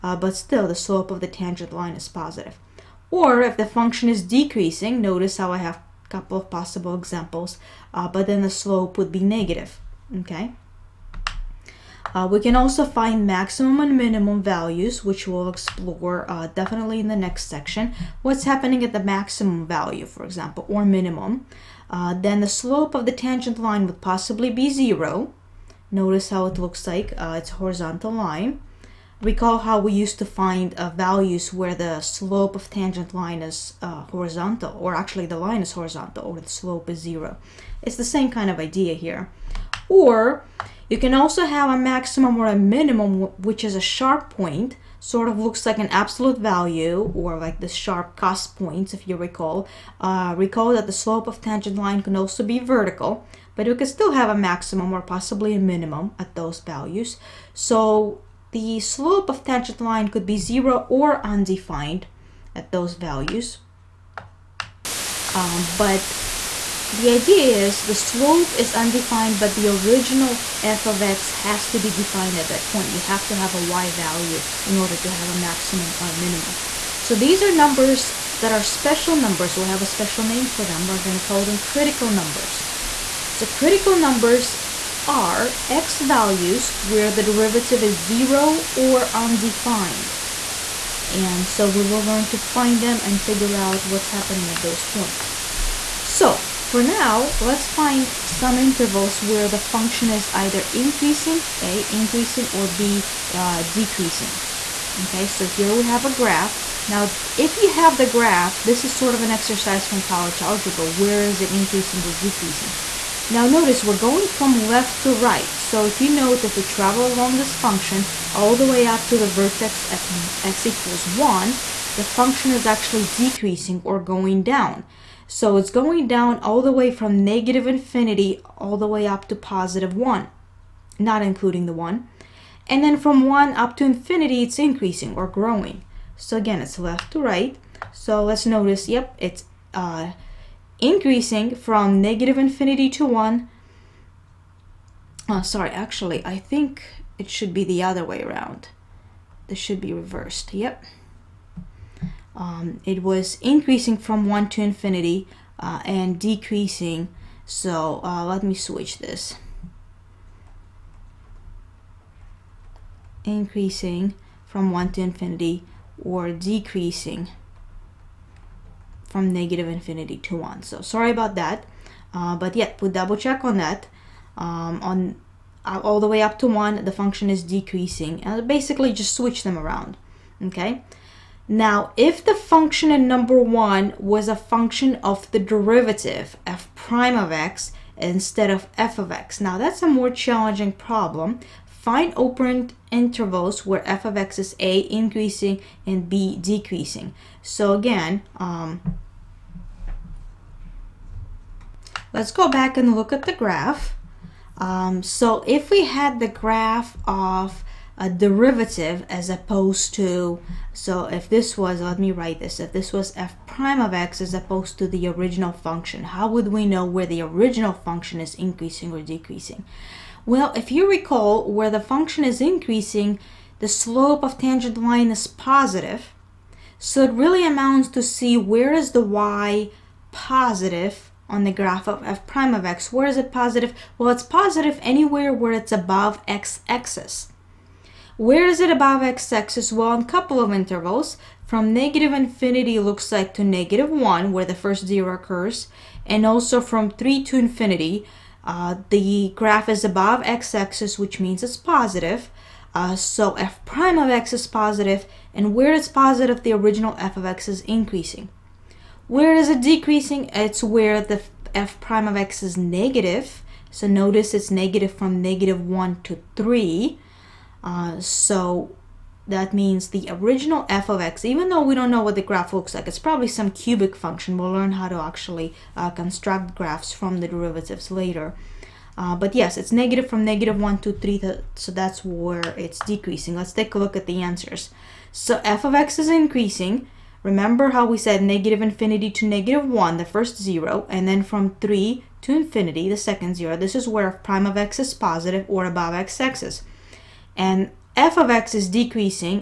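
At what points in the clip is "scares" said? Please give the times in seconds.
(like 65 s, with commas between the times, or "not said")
not said.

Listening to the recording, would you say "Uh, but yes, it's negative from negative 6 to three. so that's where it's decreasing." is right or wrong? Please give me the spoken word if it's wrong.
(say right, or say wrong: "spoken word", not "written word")
wrong: "1", not "6".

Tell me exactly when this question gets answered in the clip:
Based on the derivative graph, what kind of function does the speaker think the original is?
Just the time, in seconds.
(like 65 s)
273 s.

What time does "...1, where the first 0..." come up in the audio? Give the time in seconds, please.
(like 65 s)
243 s.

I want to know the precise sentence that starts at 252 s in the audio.
Uh, so f prime of x is positive, and where it's positive, the original f of x is increasing.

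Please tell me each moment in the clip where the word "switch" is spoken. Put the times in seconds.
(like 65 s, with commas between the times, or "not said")
158 s, 179 s.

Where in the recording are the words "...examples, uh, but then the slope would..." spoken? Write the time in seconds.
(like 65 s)
6 s.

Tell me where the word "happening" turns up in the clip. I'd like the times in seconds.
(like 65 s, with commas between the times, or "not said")
18 s, 94 s.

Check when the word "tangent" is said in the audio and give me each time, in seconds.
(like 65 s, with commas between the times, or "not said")
1 s, 23 s, 32 s, 51 s, 59 s, 224 s.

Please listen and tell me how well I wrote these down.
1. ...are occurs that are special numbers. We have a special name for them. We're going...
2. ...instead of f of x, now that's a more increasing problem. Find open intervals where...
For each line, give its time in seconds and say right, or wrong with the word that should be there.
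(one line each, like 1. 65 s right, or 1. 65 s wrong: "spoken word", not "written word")
1. 77 s wrong: "numbers", not "occurs"
2. 187 s wrong: "challenging", not "increasing".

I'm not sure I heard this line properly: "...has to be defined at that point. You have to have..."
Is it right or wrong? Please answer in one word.
right.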